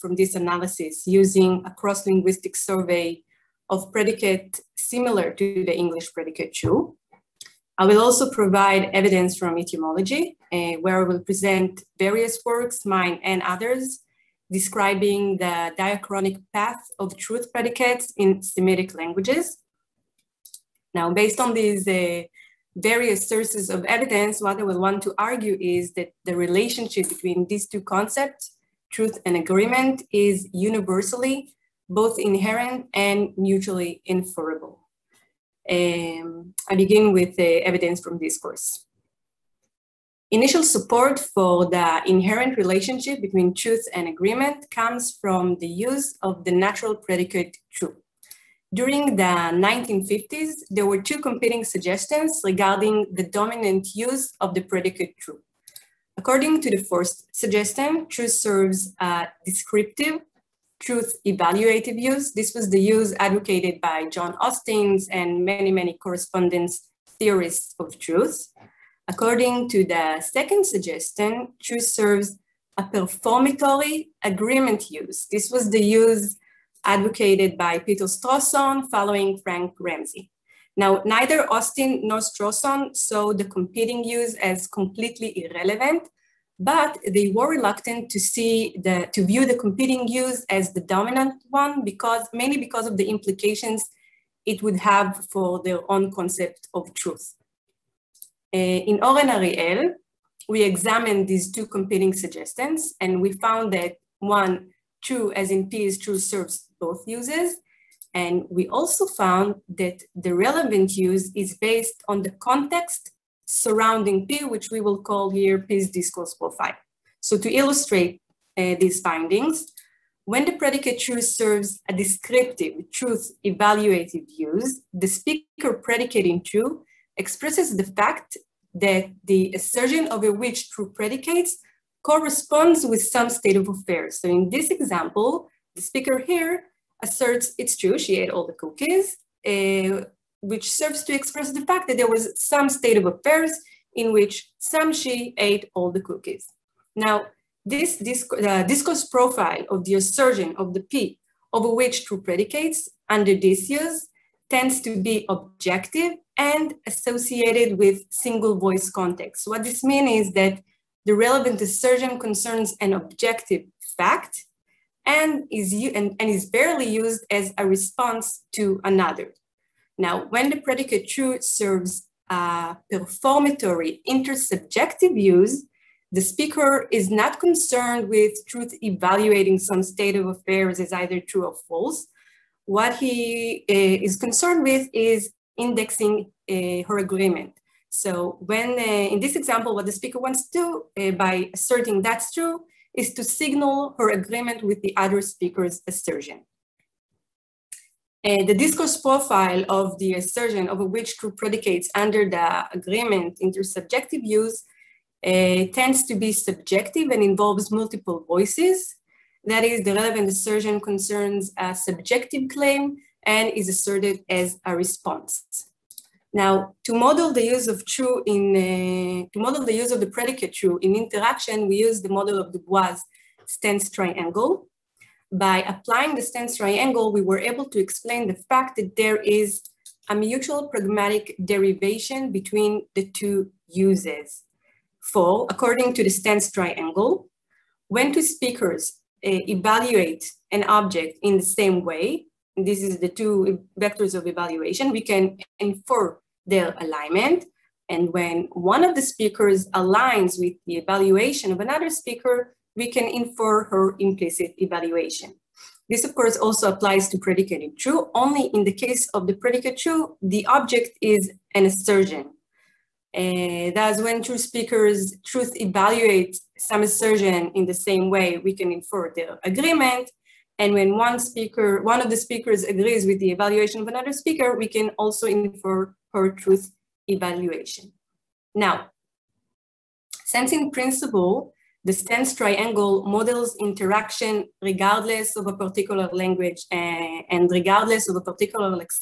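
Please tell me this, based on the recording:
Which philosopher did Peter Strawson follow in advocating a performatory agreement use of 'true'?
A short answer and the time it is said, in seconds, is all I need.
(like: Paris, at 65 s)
Frank Ramsey, at 79 s.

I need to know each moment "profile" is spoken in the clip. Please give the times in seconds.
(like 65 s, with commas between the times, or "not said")
116 s, 149 s, 199 s.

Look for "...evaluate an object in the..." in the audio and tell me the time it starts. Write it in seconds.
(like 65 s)
239 s.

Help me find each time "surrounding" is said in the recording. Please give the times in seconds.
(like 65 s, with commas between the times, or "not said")
113 s.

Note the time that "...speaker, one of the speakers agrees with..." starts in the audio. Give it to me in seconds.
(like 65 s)
271 s.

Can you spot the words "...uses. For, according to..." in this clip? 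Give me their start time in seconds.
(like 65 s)
233 s.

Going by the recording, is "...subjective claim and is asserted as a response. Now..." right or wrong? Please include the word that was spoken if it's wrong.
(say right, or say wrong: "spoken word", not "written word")
right.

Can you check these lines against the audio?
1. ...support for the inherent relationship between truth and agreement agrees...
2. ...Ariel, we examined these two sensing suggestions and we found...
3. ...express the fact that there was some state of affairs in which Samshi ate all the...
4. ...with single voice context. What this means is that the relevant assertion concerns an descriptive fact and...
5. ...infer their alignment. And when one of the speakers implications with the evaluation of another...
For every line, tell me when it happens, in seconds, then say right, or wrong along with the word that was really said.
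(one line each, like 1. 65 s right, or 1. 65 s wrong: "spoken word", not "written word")
1. 40 s wrong: "comes", not "agrees"
2. 99 s wrong: "competing", not "sensing"
3. 141 s right
4. 157 s wrong: "objective", not "descriptive"
5. 245 s wrong: "aligns", not "implications".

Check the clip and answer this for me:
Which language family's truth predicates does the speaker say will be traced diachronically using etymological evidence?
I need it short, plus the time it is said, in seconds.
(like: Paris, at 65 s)
Semitic, at 18 s.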